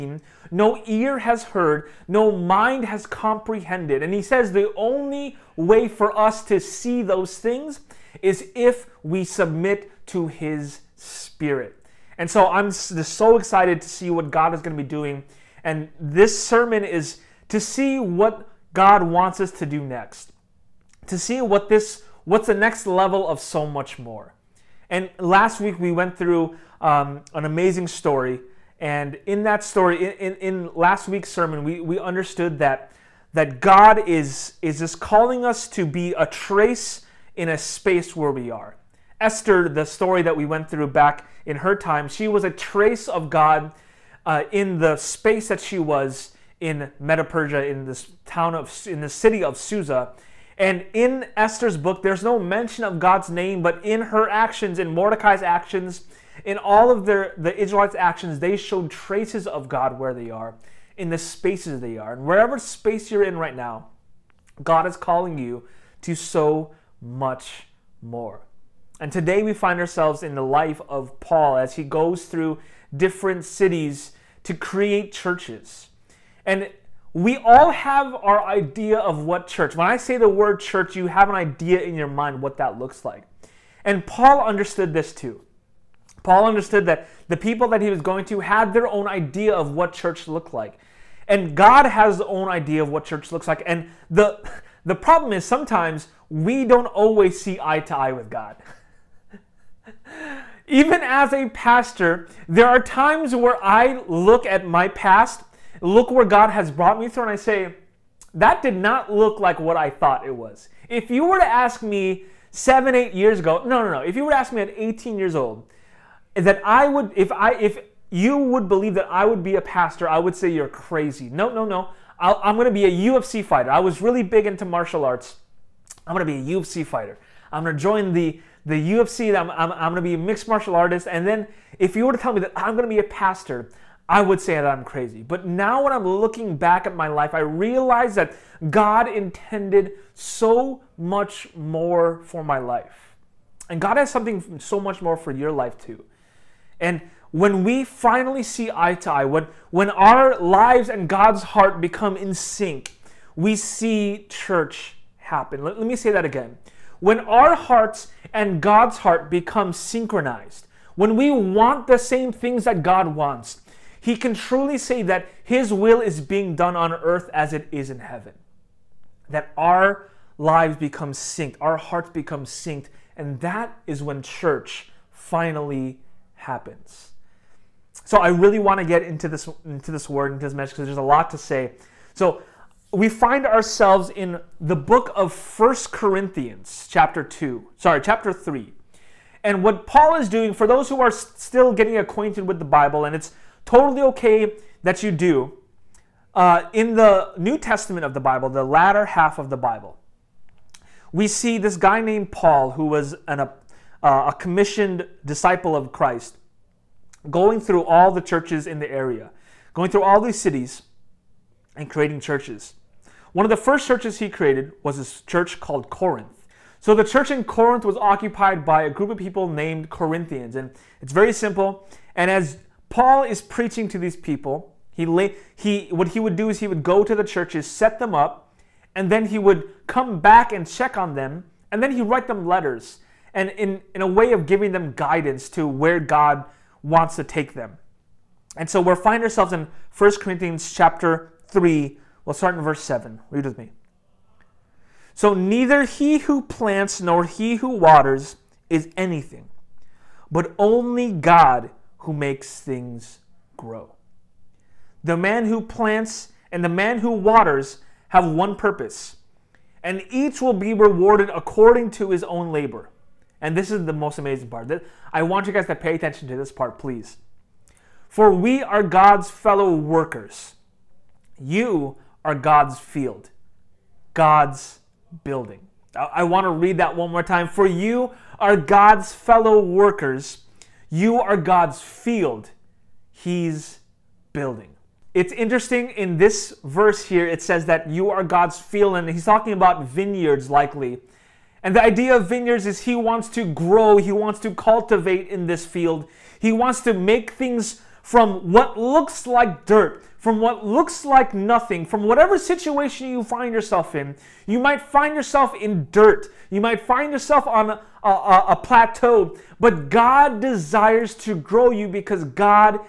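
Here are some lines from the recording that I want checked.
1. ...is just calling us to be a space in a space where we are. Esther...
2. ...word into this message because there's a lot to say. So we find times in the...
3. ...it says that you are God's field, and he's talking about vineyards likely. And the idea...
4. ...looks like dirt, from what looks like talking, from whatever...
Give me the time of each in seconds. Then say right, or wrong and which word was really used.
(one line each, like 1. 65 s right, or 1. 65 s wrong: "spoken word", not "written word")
1. 34 s wrong: "trace", not "space"
2. 180 s wrong: "ourselves", not "times"
3. 287 s right
4. 298 s wrong: "nothing", not "talking".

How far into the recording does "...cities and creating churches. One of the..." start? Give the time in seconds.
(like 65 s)
210 s.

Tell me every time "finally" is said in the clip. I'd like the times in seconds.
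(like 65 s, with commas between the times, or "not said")
147 s, 175 s.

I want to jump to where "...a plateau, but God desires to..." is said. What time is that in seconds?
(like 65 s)
308 s.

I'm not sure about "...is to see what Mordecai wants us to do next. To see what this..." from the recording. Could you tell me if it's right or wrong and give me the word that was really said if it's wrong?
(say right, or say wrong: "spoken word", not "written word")
wrong: "God", not "Mordecai".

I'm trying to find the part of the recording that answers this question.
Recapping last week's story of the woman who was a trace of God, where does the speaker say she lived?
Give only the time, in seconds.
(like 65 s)
49 s.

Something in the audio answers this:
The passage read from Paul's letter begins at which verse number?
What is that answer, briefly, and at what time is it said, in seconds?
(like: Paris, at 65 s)
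7, at 242 s.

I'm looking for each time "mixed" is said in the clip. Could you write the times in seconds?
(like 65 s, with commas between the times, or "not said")
130 s.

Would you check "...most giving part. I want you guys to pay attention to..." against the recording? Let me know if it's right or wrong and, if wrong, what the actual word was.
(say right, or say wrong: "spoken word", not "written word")
wrong: "amazing", not "giving".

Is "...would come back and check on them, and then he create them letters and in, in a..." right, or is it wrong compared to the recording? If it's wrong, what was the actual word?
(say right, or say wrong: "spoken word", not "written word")
wrong: "write", not "create".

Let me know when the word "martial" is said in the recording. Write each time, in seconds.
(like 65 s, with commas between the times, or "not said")
124 s, 130 s.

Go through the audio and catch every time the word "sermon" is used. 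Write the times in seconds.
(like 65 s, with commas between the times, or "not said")
16 s, 31 s.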